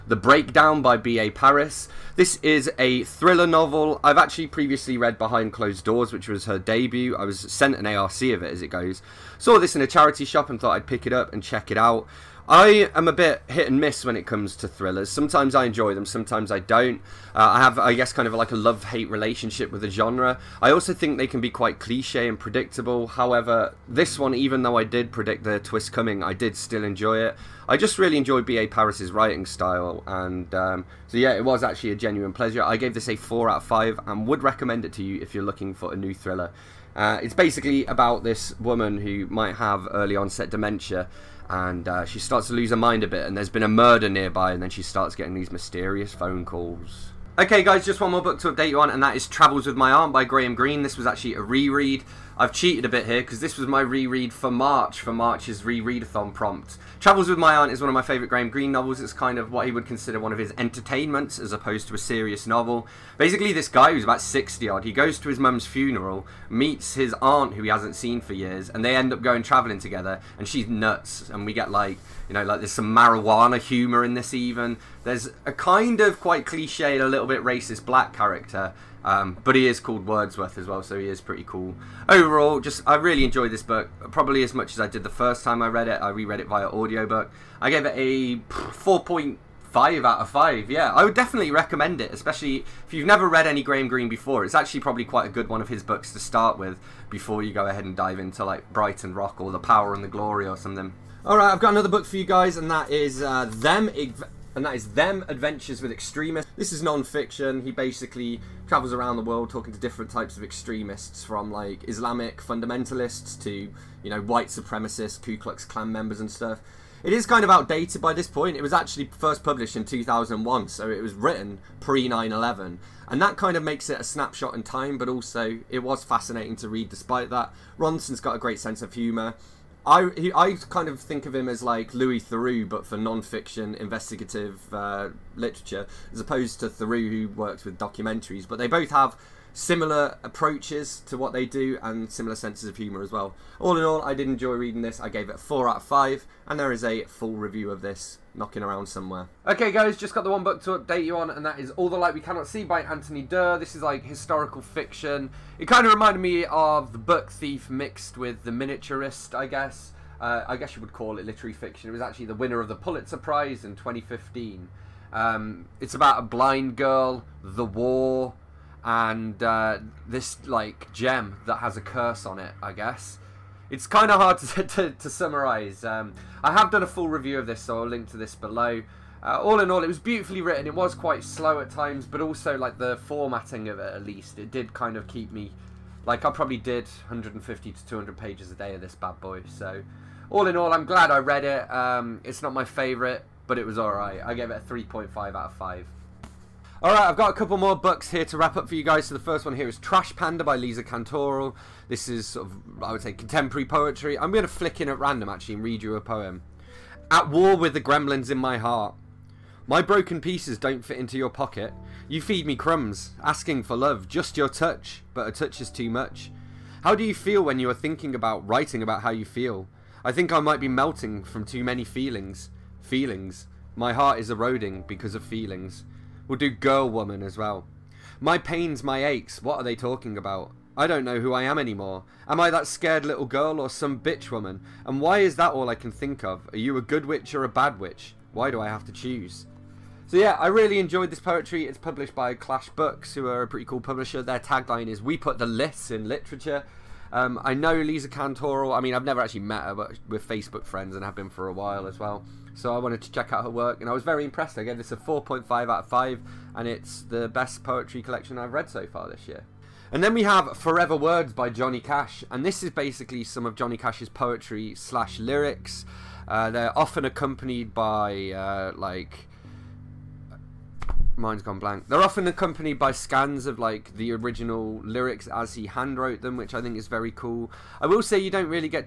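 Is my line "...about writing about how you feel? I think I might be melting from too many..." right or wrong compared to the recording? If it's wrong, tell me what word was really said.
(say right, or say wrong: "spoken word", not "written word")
right.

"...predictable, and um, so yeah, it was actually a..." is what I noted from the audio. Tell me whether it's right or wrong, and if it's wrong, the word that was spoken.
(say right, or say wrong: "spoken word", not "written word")
wrong: "style", not "predictable".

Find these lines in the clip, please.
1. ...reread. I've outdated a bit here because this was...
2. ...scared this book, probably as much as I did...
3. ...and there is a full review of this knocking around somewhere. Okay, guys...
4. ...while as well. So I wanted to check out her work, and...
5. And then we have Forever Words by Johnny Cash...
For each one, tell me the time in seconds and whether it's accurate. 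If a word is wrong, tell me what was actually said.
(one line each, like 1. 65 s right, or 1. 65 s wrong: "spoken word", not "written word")
1. 51 s wrong: "cheated", not "outdated"
2. 83 s wrong: "enjoyed", not "scared"
3. 146 s right
4. 251 s right
5. 259 s right.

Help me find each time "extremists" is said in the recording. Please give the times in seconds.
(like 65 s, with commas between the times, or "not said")
105 s, 110 s.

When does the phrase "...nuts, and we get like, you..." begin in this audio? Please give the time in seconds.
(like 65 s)
70 s.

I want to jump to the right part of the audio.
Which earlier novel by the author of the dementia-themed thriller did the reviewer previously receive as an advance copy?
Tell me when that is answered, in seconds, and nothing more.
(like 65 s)
5 s.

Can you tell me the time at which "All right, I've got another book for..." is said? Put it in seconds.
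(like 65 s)
101 s.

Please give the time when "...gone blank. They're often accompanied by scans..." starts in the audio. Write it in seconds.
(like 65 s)
271 s.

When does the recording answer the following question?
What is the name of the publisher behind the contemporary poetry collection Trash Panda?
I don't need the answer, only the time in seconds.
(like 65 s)
242 s.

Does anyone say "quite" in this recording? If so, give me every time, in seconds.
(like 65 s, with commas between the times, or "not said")
21 s, 76 s, 95 s, 180 s.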